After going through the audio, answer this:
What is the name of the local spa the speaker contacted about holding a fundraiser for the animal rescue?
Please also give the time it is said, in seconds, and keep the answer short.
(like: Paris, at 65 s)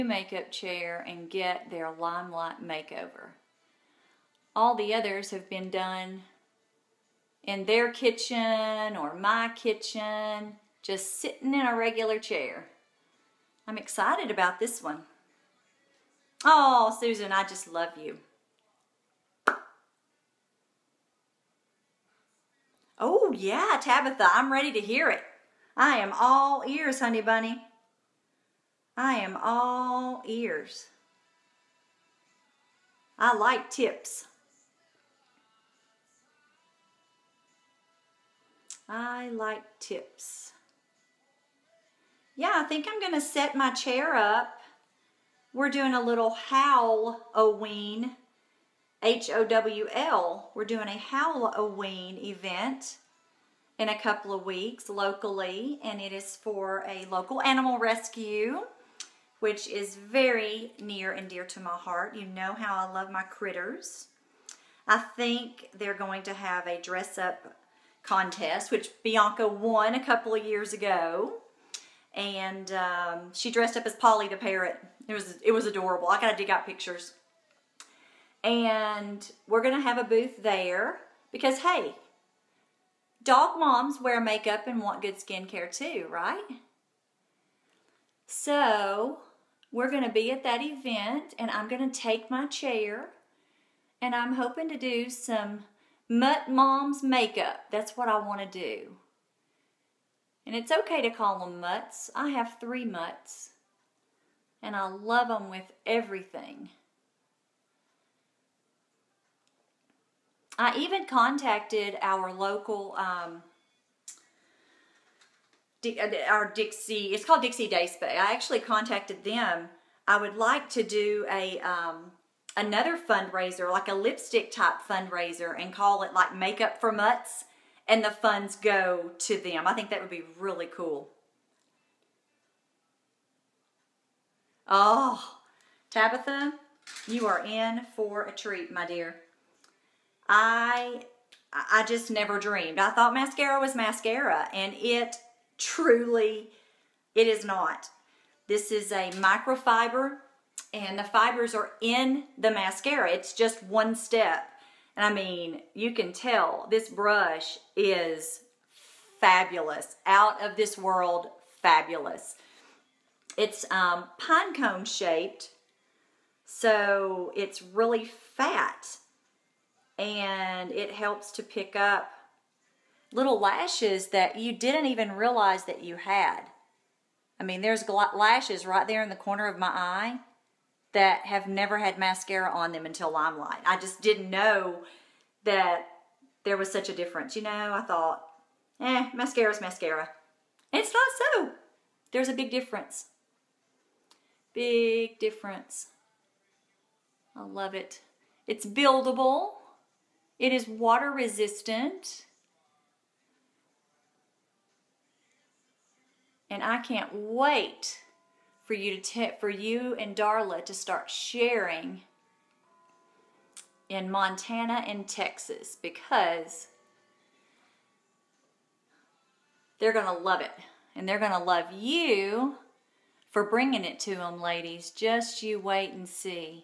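Dixie Day Spa, at 117 s.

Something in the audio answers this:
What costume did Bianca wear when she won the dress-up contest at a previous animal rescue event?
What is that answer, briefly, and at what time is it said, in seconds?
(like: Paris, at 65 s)
Polly the parrot, at 73 s.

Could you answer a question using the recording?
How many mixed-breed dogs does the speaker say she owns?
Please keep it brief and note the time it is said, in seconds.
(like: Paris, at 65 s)
3, at 102 s.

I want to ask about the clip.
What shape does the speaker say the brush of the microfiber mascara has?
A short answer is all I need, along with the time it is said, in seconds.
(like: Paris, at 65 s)
pine cone, at 164 s.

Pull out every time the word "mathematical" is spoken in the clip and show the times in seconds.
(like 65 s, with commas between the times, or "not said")
not said.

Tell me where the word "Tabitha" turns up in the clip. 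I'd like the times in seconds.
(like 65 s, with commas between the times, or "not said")
23 s, 135 s.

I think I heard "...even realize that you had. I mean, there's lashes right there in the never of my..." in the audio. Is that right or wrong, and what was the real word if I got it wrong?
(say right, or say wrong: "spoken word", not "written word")
wrong: "corner", not "never".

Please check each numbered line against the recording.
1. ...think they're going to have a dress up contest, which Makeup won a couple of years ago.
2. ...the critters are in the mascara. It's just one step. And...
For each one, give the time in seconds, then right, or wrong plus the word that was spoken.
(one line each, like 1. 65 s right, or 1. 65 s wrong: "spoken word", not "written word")
1. 64 s wrong: "Bianca", not "Makeup"
2. 150 s wrong: "fibers", not "critters".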